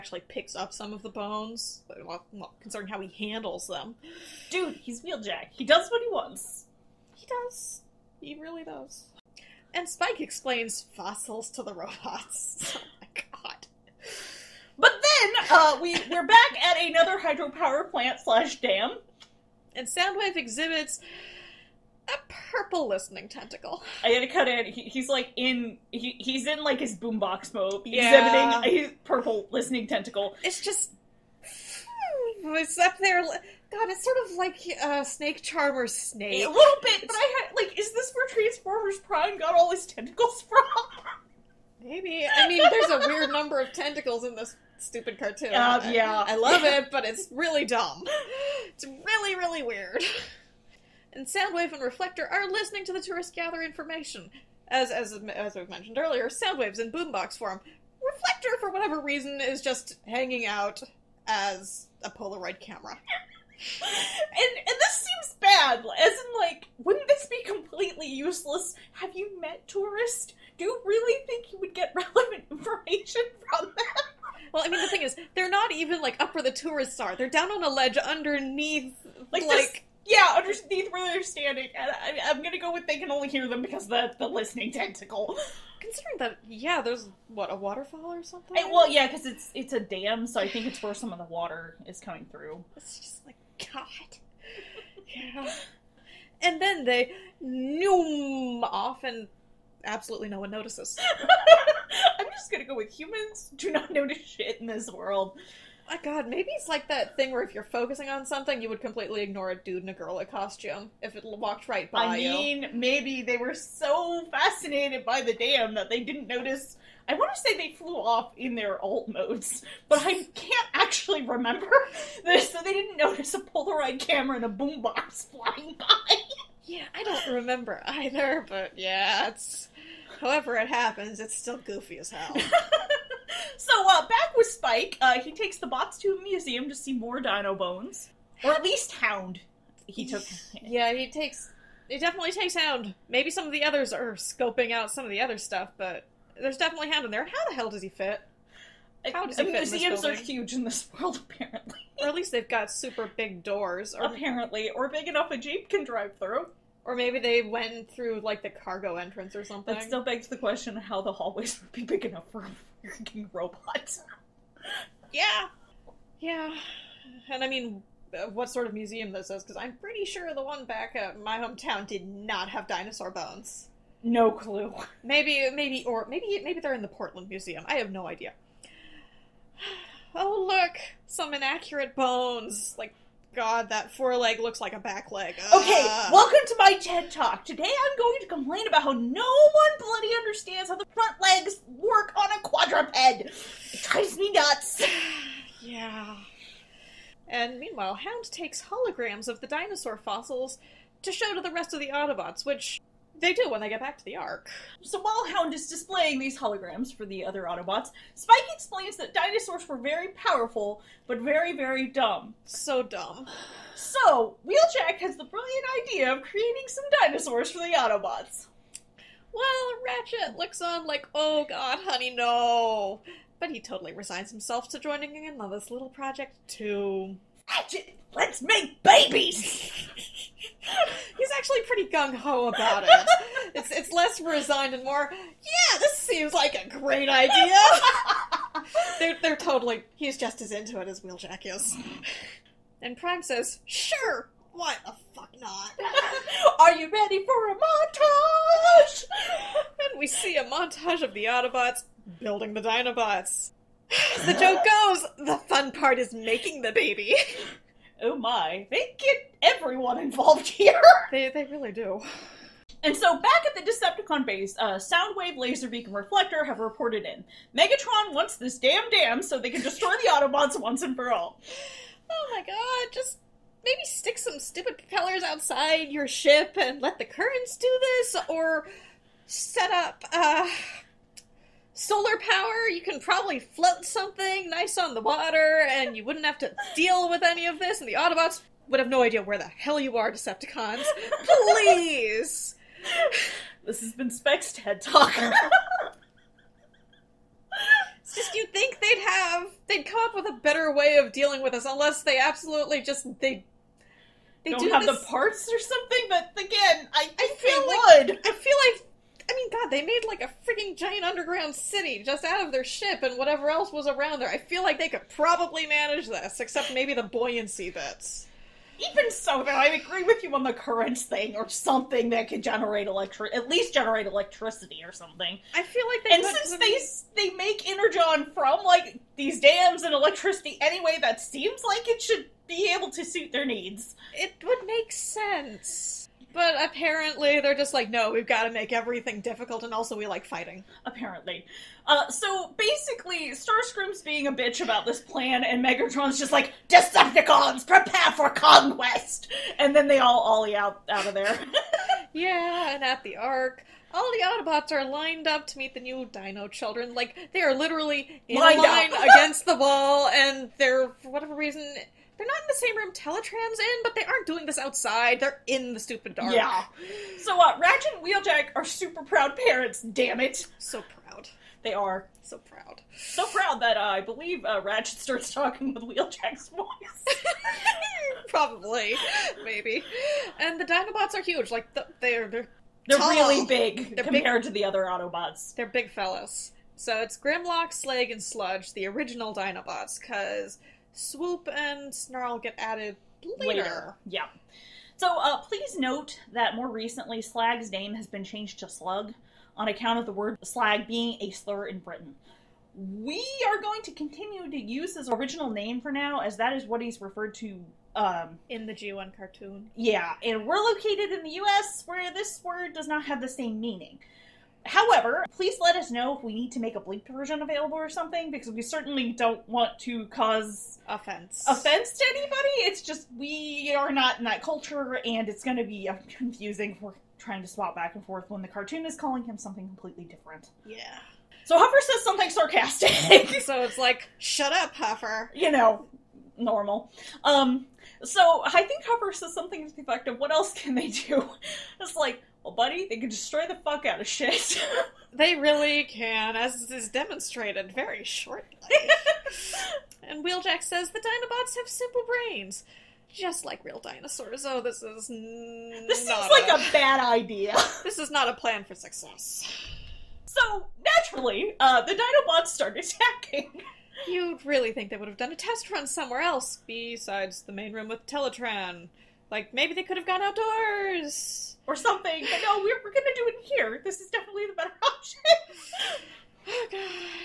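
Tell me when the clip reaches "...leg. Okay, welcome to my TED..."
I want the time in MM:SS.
03:05.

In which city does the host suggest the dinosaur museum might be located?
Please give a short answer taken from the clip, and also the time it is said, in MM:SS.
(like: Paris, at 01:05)
Portland, at 02:56.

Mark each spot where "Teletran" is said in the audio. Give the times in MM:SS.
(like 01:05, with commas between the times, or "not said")
06:02, 07:48.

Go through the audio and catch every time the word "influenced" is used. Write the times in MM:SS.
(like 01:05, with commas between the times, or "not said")
not said.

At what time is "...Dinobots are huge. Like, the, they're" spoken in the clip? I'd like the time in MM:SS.
06:20.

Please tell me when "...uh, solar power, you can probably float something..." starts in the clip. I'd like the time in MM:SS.
04:40.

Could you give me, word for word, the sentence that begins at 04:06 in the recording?
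Are you ready for a montage?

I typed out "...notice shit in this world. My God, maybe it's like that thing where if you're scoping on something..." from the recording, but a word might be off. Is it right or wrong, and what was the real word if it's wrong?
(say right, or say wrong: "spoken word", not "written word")
wrong: "focusing", not "scoping".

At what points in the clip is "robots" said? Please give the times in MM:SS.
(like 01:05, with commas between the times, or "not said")
00:11, 02:43.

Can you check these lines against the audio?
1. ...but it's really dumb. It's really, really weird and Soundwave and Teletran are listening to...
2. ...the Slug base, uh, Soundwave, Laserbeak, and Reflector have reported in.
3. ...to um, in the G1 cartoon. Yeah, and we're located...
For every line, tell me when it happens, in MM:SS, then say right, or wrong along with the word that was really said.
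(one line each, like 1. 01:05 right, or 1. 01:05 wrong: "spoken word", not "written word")
1. 00:46 wrong: "Reflector", not "Teletran"
2. 04:23 wrong: "Decepticon", not "Slug"
3. 06:47 right.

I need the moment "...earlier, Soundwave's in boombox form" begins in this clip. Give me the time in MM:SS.
00:55.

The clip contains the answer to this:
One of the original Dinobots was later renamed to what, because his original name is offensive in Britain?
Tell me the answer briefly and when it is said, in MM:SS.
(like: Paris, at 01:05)
Slug, at 06:38.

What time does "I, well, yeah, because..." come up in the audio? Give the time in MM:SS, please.
01:28.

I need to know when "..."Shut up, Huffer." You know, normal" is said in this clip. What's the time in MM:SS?
07:14.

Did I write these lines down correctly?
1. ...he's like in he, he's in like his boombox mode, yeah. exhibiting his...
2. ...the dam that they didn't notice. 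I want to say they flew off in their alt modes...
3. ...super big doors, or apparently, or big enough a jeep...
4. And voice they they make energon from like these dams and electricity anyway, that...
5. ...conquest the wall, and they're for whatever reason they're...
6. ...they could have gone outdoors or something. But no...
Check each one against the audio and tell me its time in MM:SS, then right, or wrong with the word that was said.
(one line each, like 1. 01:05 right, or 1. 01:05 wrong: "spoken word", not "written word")
1. 00:24 right
2. 01:55 right
3. 02:32 right
4. 05:26 wrong: "since", not "voice"
5. 05:58 wrong: "against", not "conquest"
6. 07:49 right.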